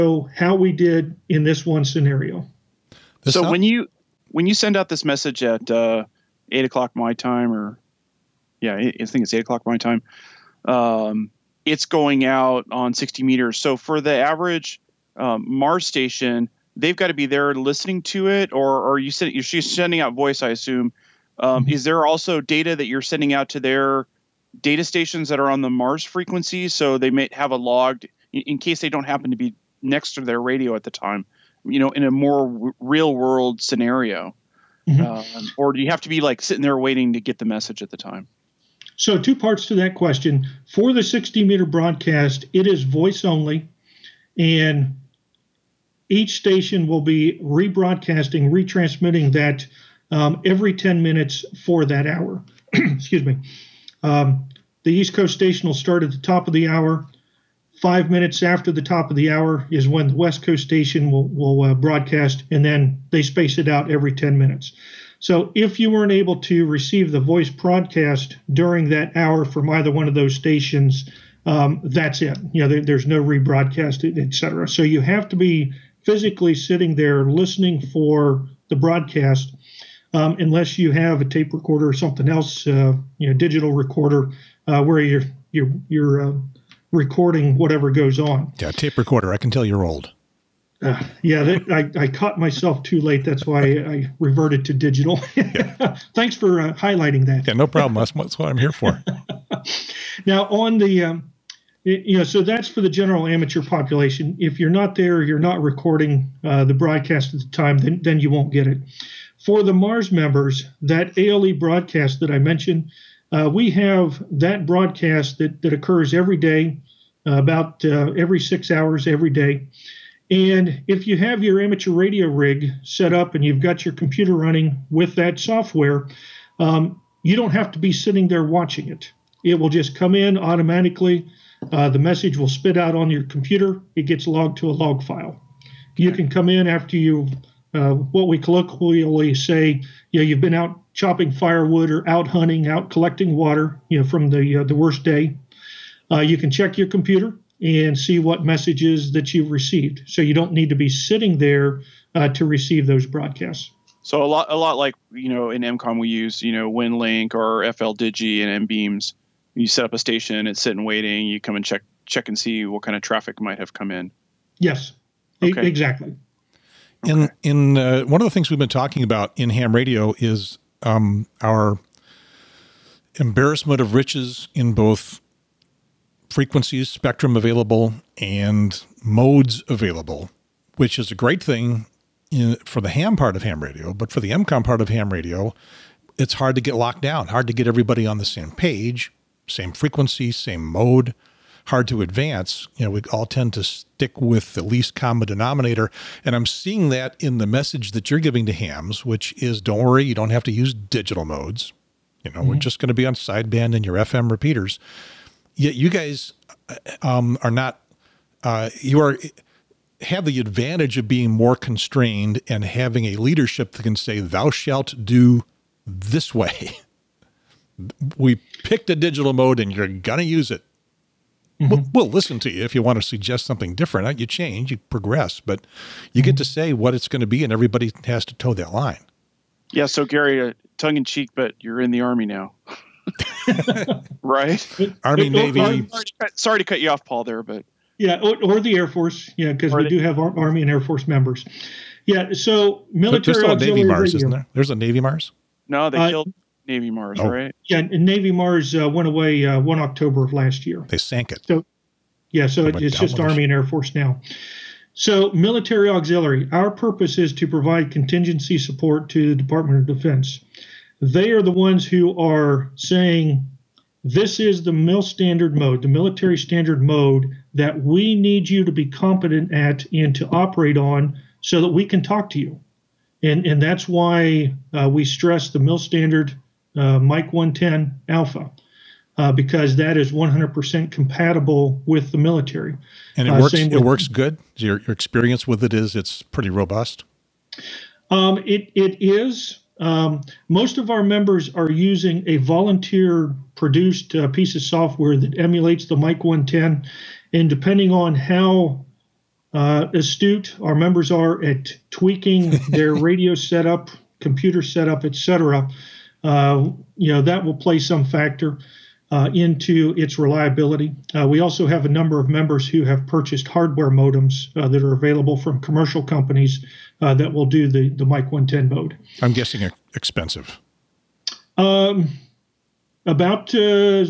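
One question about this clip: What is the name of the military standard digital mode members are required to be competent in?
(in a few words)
Mil standard 110 Alpha.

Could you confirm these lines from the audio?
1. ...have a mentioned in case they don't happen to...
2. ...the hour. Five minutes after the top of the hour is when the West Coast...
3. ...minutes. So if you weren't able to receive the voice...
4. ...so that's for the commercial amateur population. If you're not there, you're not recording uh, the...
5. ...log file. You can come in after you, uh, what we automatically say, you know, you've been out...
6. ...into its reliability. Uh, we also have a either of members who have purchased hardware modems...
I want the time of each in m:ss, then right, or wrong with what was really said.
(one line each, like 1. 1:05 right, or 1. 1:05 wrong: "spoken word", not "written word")
1. 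0:27 wrong: "logged", not "mentioned"
2. 0:56 right
3. 1:04 right
4. 1:42 wrong: "general", not "commercial"
5. 2:14 wrong: "colloquially", not "automatically"
6. 5:09 wrong: "number", not "either".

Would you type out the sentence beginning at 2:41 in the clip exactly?
You come and check check and see what kind of traffic might have come in.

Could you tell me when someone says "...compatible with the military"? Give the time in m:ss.
4:40.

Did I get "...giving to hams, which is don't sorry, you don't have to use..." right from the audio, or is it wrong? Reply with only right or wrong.
wrong.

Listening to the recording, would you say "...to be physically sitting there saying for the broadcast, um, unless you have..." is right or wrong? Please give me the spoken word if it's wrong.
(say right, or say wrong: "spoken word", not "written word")
wrong: "listening", not "saying".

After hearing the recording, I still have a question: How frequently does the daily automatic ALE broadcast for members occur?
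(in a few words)
Every 6 hours.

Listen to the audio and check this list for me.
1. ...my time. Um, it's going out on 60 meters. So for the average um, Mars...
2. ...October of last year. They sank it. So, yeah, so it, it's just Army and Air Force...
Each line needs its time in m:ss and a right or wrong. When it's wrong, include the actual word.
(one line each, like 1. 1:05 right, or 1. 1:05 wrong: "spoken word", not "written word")
1. 0:09 right
2. 4:09 right.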